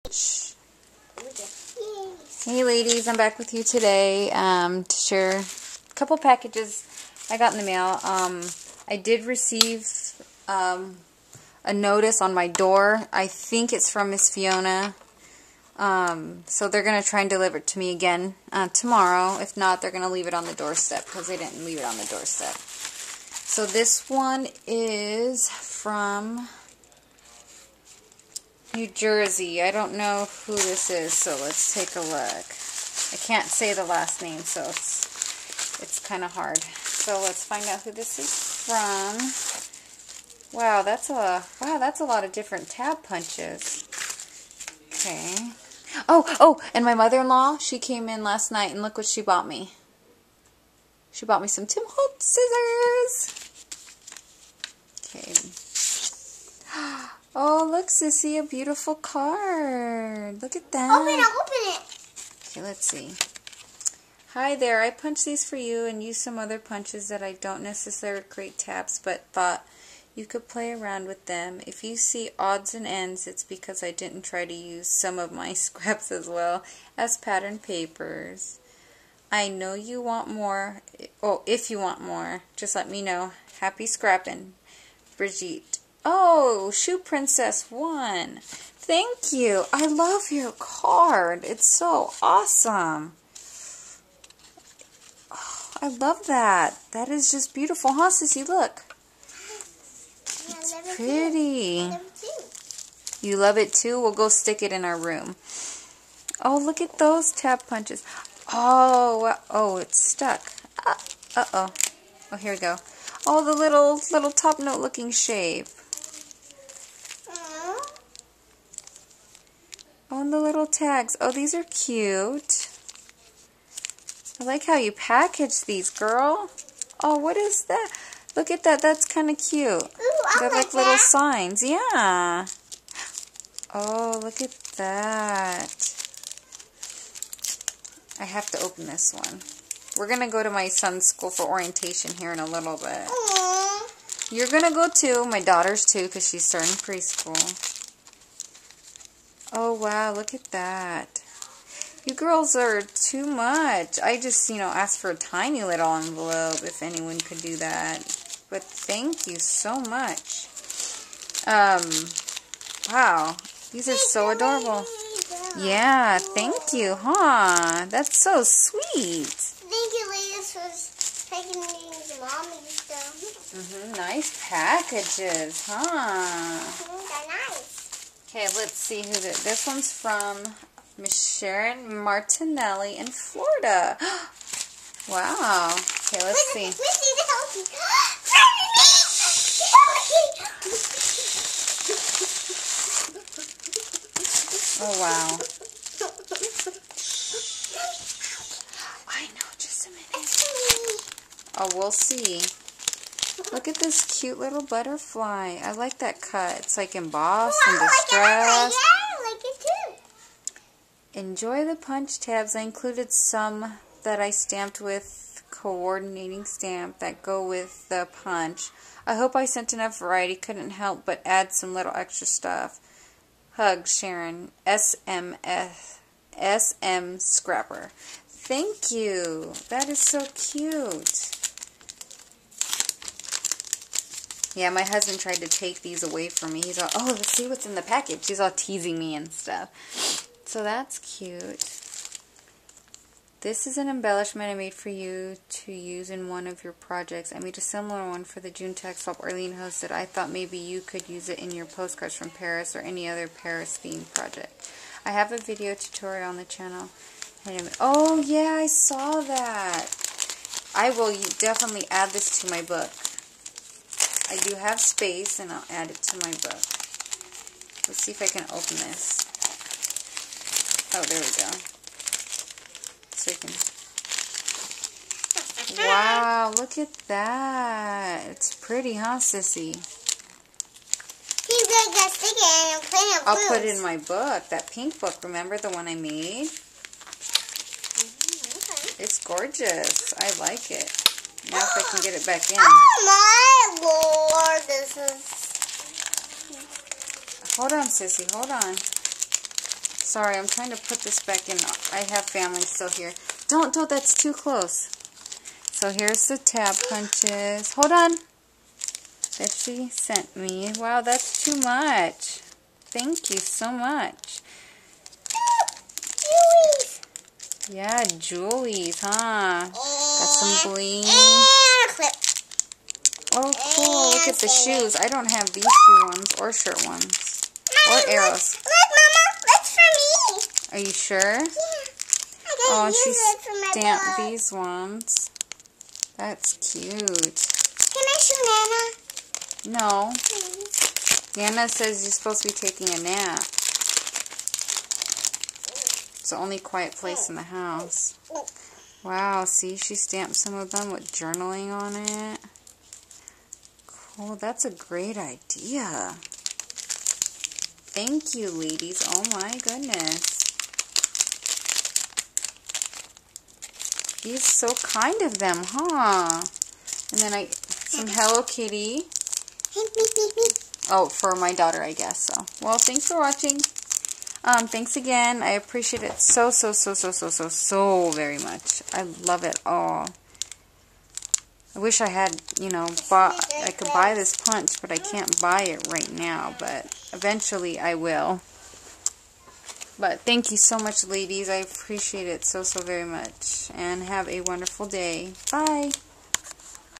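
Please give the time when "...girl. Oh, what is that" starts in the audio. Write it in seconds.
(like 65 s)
125 s.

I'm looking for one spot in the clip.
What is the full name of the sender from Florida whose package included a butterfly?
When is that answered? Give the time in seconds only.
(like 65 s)
181 s.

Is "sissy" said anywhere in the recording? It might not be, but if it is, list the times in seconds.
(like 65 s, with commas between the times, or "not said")
57 s, 98 s, 279 s, 297 s.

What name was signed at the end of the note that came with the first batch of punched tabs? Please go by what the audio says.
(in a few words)
Brigitte.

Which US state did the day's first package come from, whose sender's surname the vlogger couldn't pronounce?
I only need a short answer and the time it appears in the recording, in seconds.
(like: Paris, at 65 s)
New Jersey, at 28 s.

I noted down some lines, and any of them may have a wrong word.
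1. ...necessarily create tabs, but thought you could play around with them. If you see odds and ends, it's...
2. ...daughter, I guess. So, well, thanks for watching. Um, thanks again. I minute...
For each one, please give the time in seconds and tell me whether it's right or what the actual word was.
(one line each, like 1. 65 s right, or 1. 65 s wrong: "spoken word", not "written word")
1. 67 s right
2. 371 s wrong: "appreciate", not "minute".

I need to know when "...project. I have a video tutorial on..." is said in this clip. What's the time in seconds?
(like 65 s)
254 s.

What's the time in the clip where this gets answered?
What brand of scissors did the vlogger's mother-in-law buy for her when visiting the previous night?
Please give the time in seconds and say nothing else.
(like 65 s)
51 s.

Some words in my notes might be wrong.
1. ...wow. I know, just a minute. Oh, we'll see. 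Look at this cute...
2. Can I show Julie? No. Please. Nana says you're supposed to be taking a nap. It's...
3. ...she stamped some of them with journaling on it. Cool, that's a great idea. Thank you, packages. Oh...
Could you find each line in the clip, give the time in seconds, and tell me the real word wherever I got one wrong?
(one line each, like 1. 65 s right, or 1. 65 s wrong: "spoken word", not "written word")
1. 195 s right
2. 337 s wrong: "Nana", not "Julie"
3. 349 s wrong: "ladies", not "packages".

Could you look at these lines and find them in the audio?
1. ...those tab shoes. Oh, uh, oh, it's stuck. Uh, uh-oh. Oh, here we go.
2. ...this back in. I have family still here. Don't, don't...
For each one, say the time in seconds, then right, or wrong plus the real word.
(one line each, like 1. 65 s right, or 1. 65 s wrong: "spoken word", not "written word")
1. 106 s wrong: "punches", not "shoes"
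2. 300 s right.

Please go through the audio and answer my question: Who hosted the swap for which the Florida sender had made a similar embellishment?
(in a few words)
Arlene.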